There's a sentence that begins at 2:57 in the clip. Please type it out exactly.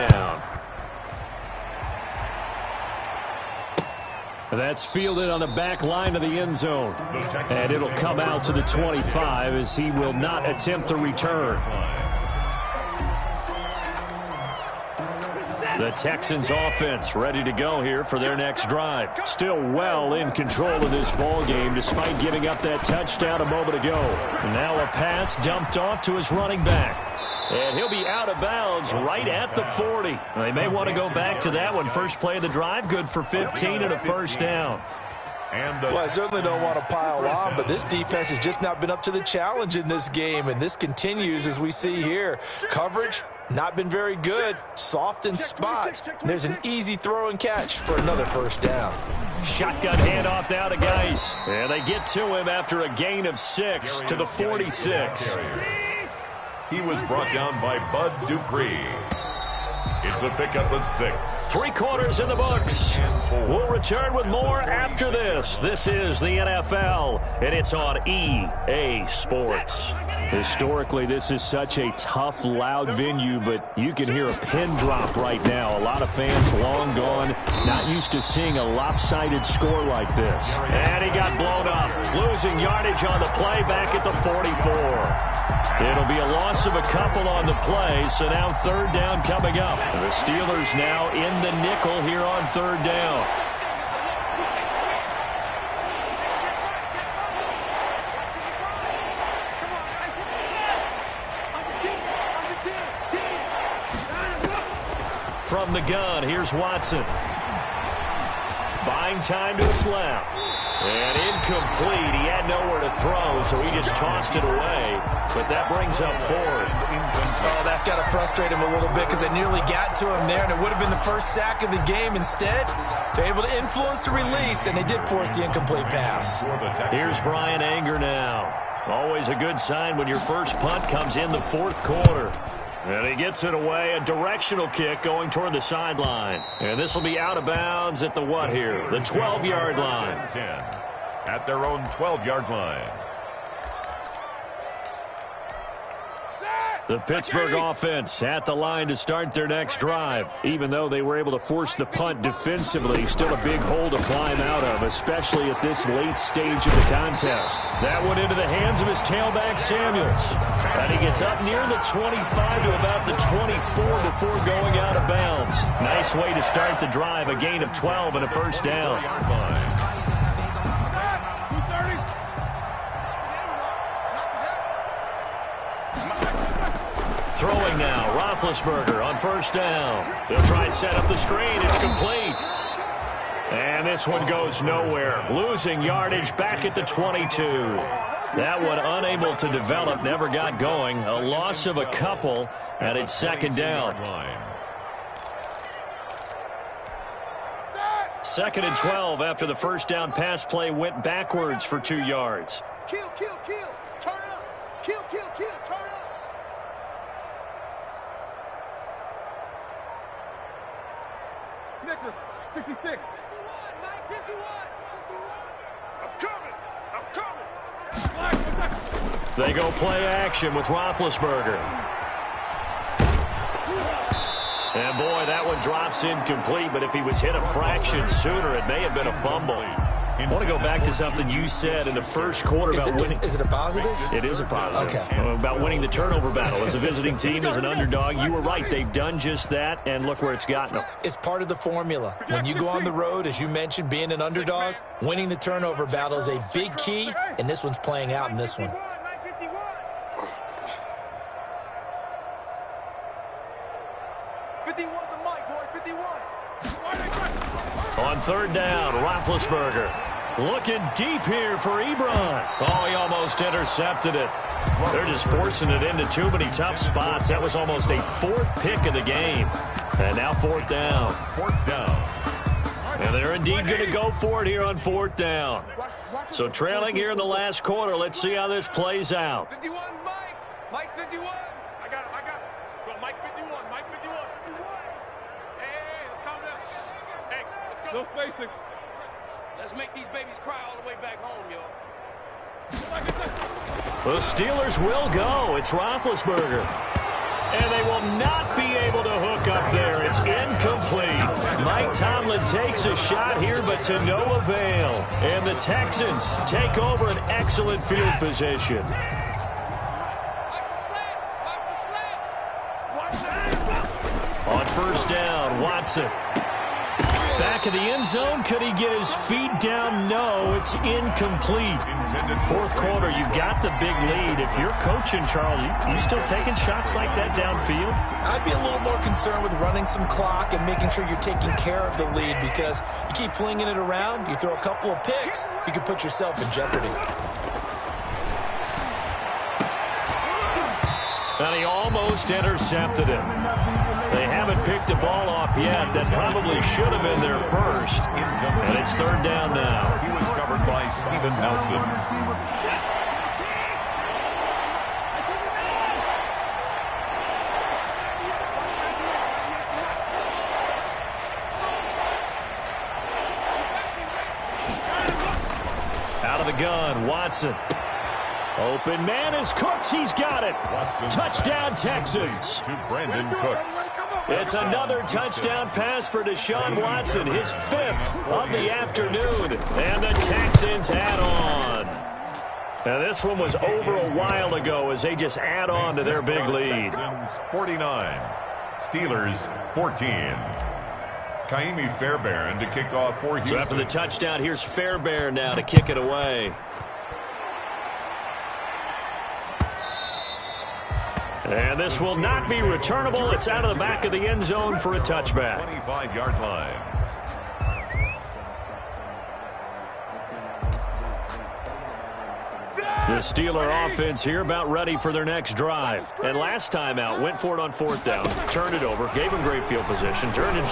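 Throwing now, Roethlisberger on first down.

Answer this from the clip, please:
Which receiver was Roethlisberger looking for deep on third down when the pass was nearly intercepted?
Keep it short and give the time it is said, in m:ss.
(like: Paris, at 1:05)
Ebron, at 4:21.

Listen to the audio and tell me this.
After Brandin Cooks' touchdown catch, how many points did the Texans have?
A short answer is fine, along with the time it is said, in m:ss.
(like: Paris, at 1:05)
49, at 6:27.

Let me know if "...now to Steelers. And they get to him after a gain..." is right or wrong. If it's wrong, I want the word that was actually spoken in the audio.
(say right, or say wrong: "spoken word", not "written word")
wrong: "Geis", not "Steelers".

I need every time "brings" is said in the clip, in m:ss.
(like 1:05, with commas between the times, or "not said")
1:55.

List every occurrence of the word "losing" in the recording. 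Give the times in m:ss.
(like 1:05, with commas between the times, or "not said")
1:22, 3:05.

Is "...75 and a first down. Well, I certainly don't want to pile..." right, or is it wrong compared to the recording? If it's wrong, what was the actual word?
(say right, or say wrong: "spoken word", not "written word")
wrong: "15", not "75".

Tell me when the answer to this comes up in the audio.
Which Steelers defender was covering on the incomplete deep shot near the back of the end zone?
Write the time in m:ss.
5:50.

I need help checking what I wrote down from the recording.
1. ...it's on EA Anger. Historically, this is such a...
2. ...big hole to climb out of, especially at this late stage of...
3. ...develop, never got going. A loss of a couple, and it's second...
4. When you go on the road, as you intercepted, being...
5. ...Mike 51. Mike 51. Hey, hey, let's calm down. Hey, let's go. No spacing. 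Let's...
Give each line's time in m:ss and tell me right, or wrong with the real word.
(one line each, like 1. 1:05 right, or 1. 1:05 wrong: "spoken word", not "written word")
1. 1:07 wrong: "Sports", not "Anger"
2. 2:33 right
3. 3:09 right
4. 4:02 wrong: "mentioned", not "intercepted"
5. 4:43 right.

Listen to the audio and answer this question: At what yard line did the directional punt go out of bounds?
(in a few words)
12.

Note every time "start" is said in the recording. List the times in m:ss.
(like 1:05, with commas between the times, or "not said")
2:28, 2:46.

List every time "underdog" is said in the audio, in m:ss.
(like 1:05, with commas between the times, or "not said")
3:57, 4:04.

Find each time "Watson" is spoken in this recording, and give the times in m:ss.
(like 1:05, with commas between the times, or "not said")
1:46, 5:15, 6:07, 6:16.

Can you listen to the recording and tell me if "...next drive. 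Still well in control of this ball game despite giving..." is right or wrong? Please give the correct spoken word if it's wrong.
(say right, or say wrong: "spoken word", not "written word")
right.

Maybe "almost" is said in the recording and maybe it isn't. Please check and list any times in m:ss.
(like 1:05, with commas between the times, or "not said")
4:22, 4:27, 5:41.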